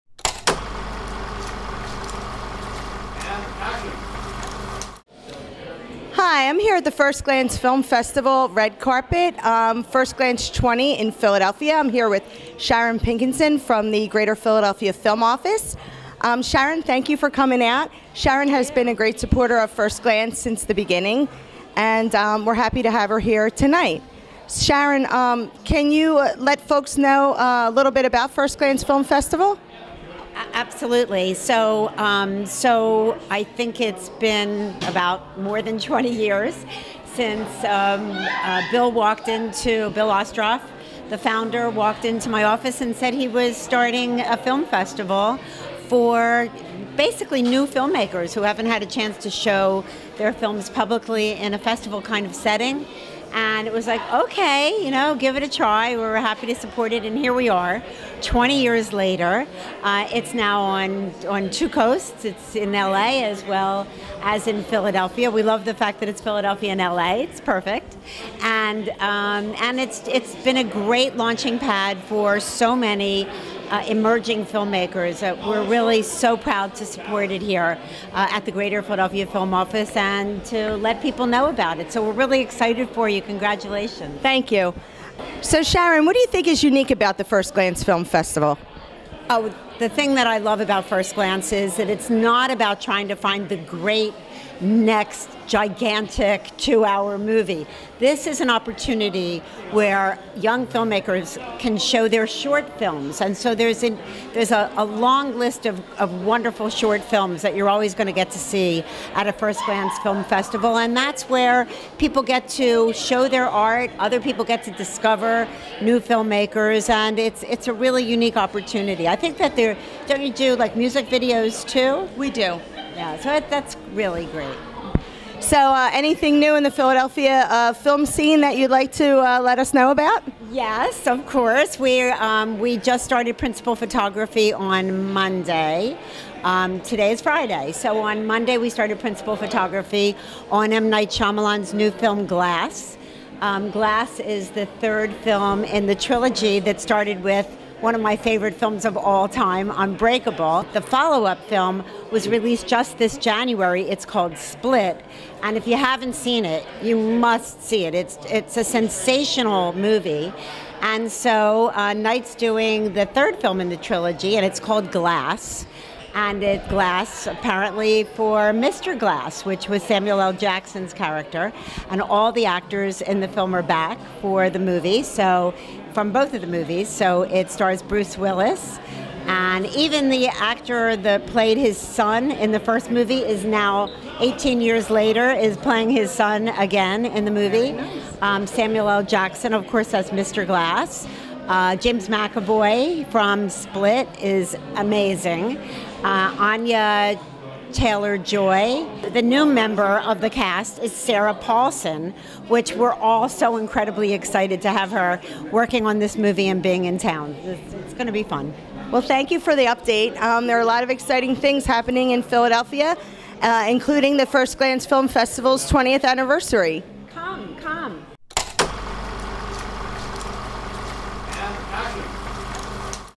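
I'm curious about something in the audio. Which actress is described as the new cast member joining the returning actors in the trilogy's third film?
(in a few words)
Sarah Paulson.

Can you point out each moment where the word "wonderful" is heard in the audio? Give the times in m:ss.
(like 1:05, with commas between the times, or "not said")
1:46.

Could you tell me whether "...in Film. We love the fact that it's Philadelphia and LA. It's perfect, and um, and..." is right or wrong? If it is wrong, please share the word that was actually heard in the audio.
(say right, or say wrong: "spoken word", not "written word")
wrong: "Philadelphia", not "Film".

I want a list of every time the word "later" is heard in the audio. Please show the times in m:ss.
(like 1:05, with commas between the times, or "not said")
0:58, 3:04.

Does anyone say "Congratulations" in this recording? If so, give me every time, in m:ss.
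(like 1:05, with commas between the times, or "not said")
1:23.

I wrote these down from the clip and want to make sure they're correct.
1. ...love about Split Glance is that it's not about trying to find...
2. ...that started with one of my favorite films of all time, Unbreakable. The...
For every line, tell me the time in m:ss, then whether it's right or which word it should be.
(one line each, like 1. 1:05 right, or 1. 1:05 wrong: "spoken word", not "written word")
1. 1:30 wrong: "First", not "Split"
2. 2:26 right.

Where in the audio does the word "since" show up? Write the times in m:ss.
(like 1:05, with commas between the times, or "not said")
0:20, 0:37.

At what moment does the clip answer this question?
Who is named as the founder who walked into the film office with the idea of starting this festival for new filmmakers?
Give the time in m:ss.
0:39.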